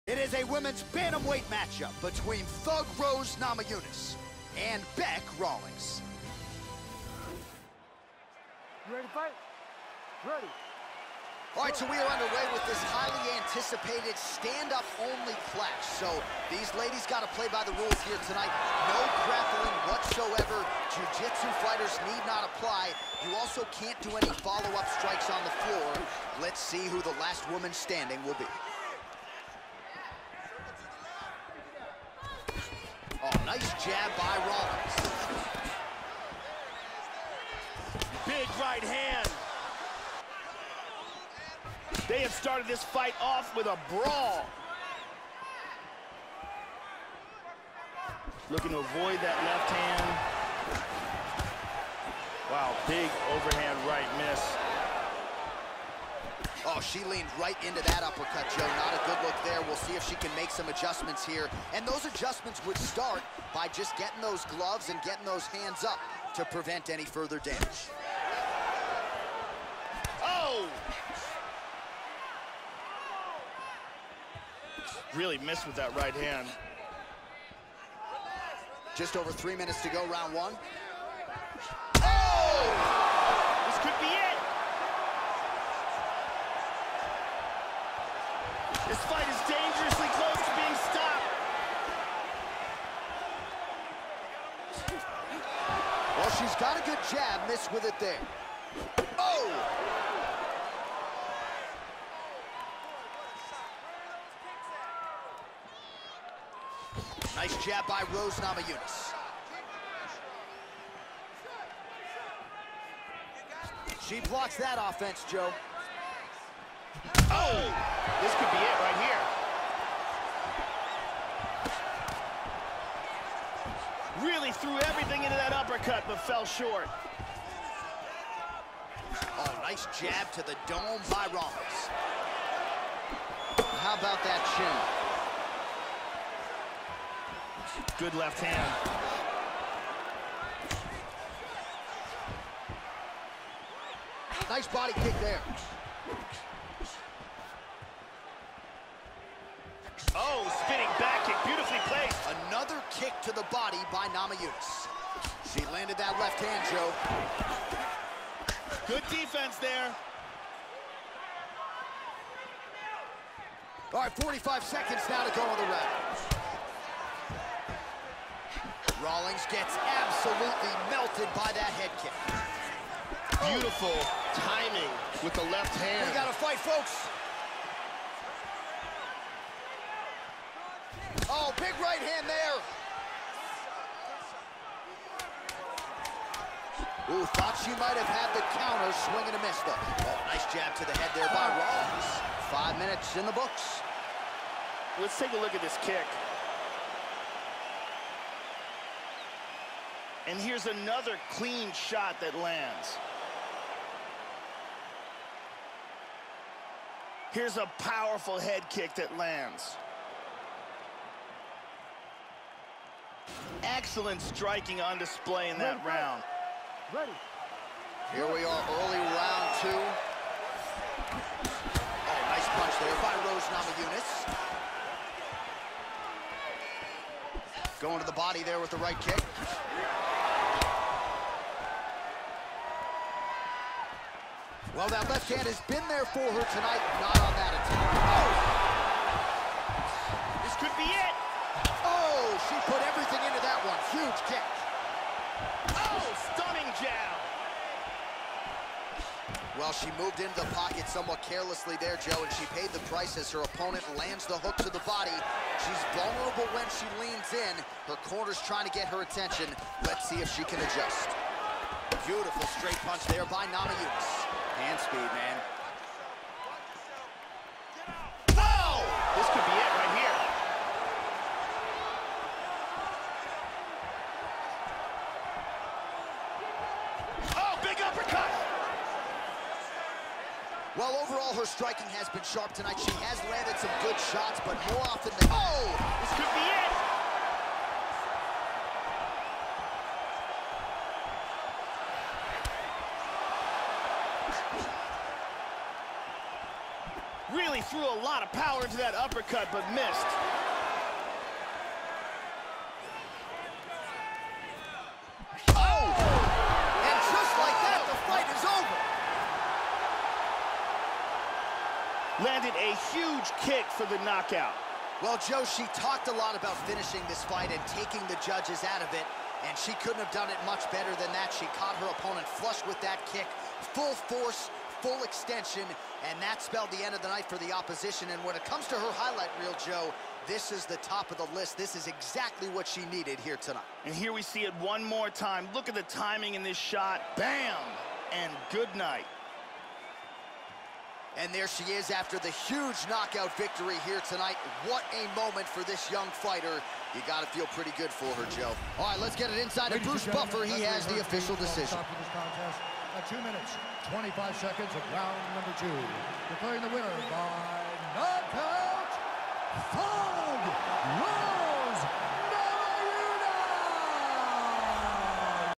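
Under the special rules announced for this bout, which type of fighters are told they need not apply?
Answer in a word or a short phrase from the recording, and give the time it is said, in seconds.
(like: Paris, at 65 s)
Jiu-jitsu fighters, at 20 s.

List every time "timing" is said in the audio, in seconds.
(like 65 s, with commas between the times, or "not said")
174 s, 335 s.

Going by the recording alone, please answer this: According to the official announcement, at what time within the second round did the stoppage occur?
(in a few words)
2 minutes 25 seconds.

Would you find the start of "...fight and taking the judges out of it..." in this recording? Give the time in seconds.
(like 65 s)
317 s.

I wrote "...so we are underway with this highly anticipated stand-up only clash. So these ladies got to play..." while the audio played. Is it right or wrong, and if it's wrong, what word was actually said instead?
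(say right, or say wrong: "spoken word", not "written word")
right.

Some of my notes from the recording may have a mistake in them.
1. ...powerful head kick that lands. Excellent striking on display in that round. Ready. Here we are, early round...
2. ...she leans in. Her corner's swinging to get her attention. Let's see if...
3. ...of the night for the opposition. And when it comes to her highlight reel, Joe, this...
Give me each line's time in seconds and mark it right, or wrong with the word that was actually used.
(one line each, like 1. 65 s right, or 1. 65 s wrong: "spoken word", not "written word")
1. 207 s right
2. 256 s wrong: "trying", not "swinging"
3. 326 s right.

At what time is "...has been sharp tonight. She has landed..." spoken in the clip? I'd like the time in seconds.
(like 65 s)
281 s.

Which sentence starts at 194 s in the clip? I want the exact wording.
Let's take a look at this kick.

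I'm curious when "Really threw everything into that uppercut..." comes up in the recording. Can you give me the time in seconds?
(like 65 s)
124 s.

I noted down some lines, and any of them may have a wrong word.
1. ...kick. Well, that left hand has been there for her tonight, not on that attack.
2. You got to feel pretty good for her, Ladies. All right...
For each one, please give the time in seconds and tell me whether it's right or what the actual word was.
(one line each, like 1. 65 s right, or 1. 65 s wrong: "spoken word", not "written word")
1. 228 s right
2. 346 s wrong: "Joe", not "Ladies".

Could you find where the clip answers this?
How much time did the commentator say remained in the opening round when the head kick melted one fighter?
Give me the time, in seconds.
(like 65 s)
164 s.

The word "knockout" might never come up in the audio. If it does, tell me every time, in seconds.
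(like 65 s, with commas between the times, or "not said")
314 s, 342 s, 357 s.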